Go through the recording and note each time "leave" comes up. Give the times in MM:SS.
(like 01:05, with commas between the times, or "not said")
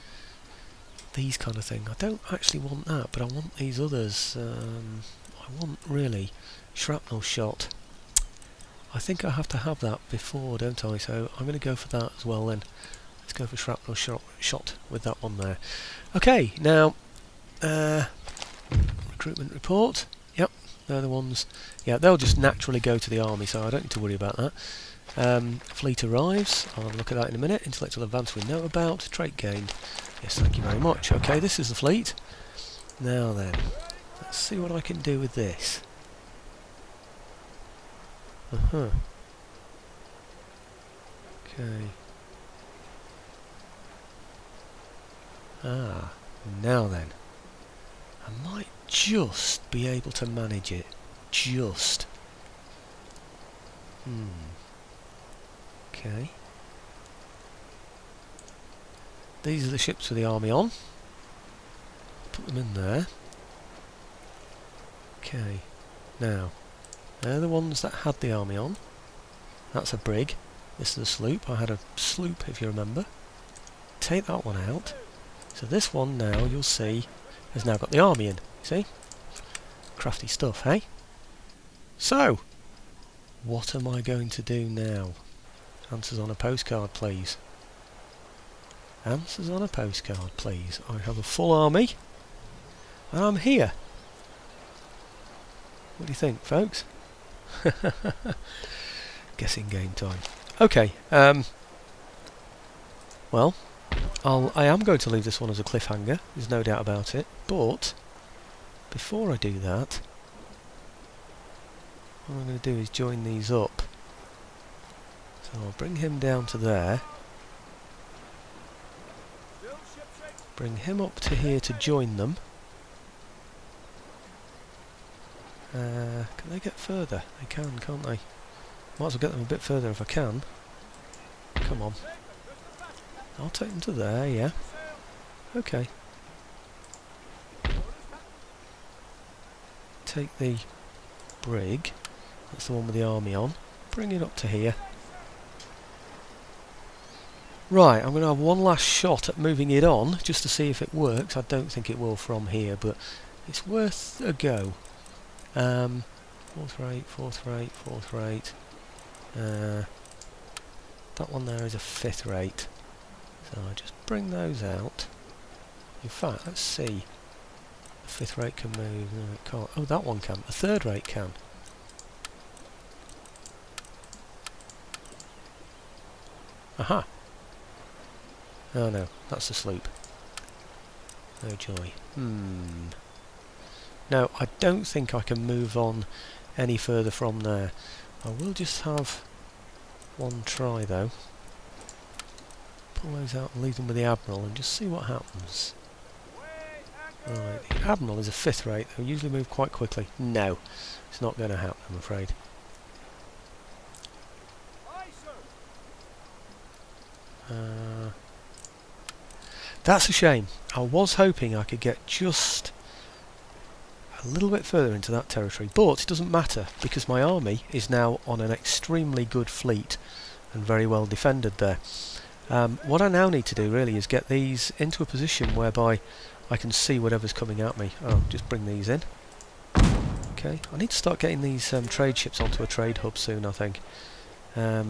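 01:45, 03:13.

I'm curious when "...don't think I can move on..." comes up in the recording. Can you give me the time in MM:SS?
03:04.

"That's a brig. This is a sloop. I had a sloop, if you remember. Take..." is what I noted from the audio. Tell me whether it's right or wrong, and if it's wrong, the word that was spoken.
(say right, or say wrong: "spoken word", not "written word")
right.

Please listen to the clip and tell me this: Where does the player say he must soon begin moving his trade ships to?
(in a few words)
A trade hub.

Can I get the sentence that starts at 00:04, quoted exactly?
Um, I want, really, shrapnel shot.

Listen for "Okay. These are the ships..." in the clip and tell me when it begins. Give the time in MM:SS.
00:55.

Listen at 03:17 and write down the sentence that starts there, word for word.
Right, the Admiral is a fifth rate, they'll usually move quite quickly.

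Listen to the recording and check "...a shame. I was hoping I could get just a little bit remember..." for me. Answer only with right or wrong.
wrong.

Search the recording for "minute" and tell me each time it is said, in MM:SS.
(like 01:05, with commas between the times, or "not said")
00:27.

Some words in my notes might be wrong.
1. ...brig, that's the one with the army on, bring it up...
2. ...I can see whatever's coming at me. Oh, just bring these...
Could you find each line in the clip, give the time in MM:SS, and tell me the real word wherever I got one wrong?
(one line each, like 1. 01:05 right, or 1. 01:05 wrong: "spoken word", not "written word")
1. 02:21 right
2. 03:46 right.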